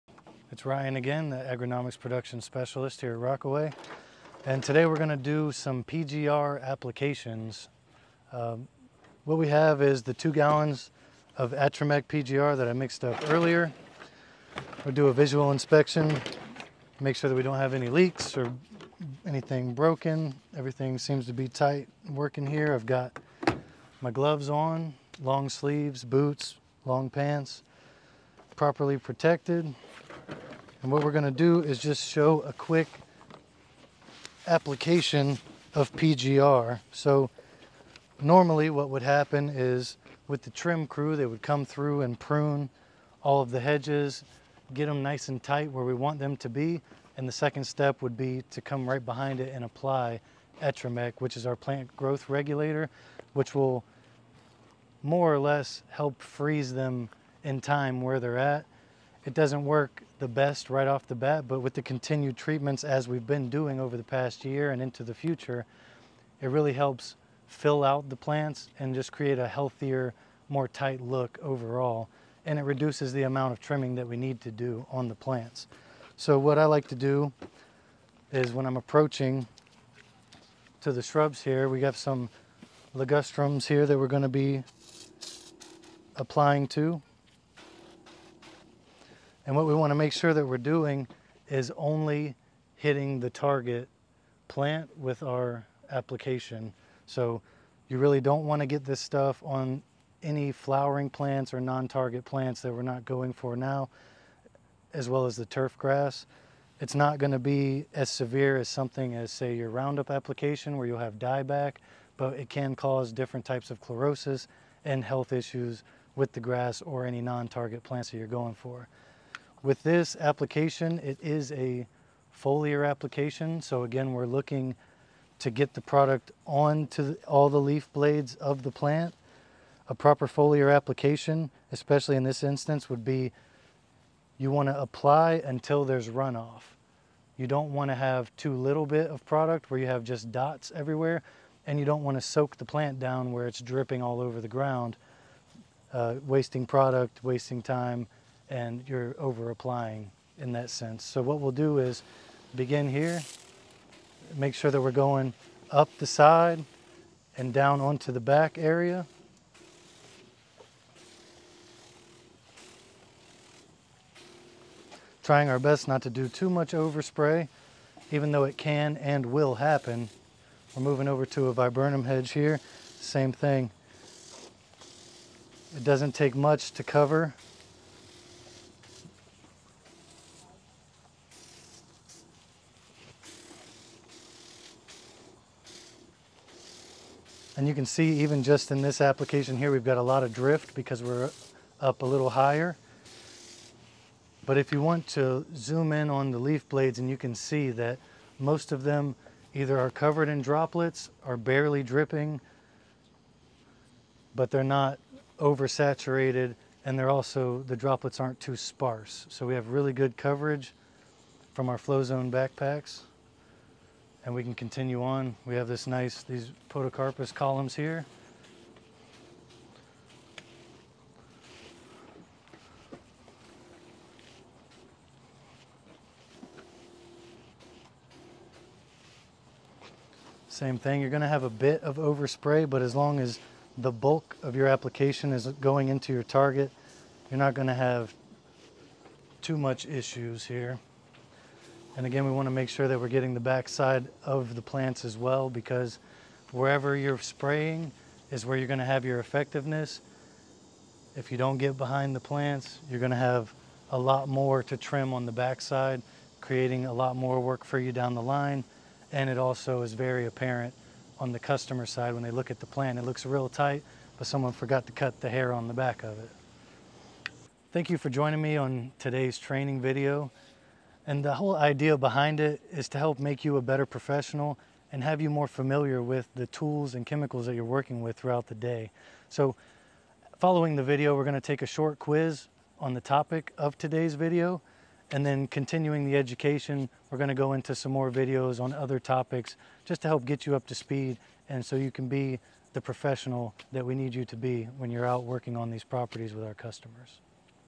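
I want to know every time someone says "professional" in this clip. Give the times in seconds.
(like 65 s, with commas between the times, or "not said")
273 s, 292 s.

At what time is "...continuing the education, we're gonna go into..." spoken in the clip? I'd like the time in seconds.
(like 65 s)
285 s.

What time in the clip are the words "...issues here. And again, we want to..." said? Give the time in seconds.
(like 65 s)
239 s.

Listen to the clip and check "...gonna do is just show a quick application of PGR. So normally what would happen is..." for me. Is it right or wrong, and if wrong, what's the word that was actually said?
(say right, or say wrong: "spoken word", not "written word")
right.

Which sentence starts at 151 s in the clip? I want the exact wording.
So what we'll do is begin here, make sure that we're going up the side and down onto the back area.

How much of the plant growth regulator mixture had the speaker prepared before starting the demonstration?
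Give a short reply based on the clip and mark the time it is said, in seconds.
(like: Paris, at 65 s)
2 gallons, at 10 s.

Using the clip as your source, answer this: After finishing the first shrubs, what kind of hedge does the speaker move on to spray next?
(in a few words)
viburnum.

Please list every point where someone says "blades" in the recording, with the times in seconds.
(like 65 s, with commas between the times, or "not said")
127 s, 196 s.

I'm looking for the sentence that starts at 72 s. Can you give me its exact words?
And it reduces the amount of trimming that we need to do on the plants.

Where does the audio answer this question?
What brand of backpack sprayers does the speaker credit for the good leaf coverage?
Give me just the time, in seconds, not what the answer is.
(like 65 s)
211 s.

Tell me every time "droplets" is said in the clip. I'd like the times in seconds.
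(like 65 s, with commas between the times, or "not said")
200 s, 207 s.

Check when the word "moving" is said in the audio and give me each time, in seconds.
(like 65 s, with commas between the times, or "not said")
170 s.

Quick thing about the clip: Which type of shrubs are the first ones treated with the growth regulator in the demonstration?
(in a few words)
ligustrums.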